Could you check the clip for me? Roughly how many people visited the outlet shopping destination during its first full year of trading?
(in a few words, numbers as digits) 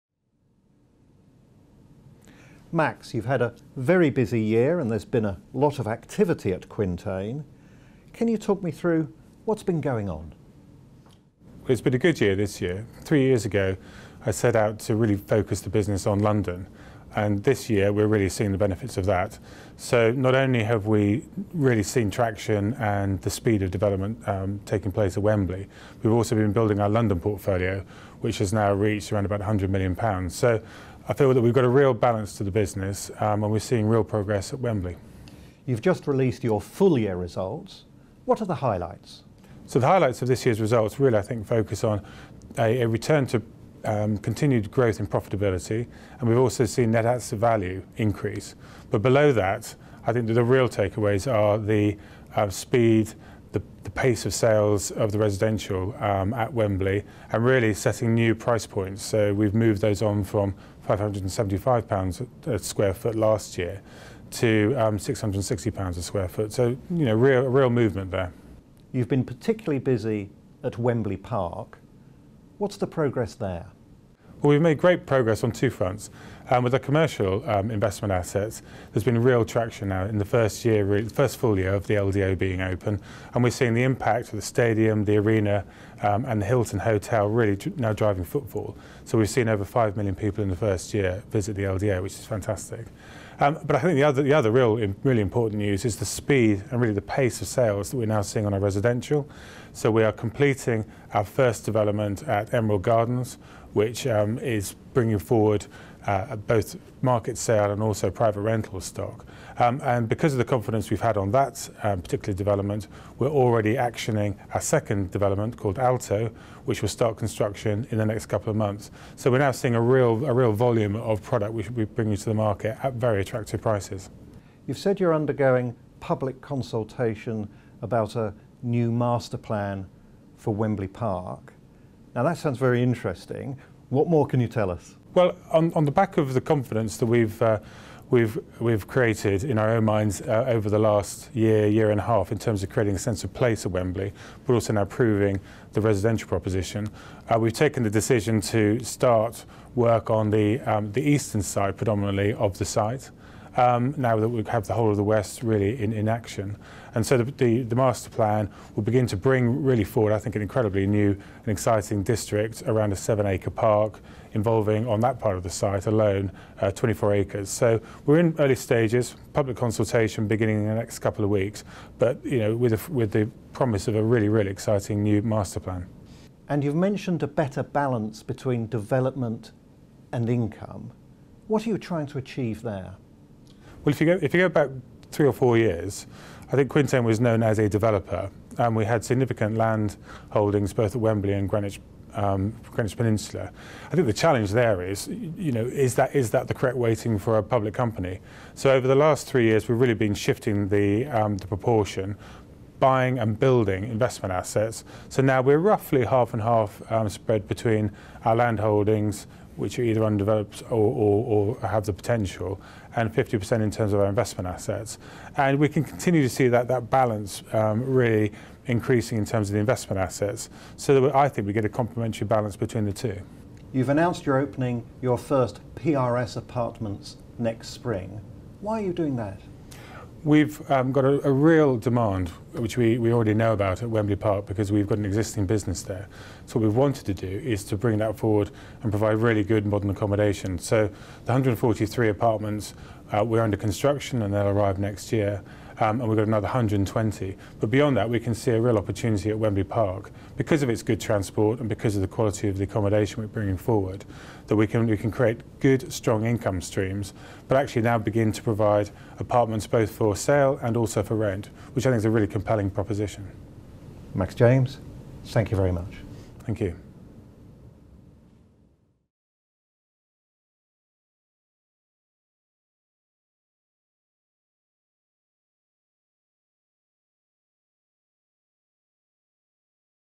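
Over 5 million.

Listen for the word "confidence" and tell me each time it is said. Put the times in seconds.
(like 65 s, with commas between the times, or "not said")
110 s, 136 s.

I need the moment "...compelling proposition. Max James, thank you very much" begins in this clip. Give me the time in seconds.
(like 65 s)
262 s.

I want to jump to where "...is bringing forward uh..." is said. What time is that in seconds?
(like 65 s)
104 s.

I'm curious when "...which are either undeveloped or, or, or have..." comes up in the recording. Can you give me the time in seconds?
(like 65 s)
209 s.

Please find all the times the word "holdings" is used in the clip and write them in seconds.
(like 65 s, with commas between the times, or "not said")
190 s, 208 s.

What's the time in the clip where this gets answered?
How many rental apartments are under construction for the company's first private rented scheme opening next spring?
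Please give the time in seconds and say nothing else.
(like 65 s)
241 s.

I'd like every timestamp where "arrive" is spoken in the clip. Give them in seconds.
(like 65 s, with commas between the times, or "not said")
244 s.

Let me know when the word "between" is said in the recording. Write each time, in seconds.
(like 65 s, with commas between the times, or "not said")
178 s, 207 s, 222 s.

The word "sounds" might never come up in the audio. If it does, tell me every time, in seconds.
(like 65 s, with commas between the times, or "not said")
132 s.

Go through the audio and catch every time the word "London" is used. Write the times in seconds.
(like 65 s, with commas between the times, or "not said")
16 s, 26 s.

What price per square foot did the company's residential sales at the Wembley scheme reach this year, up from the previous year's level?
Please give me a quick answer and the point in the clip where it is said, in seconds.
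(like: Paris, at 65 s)
£660 a square foot, at 64 s.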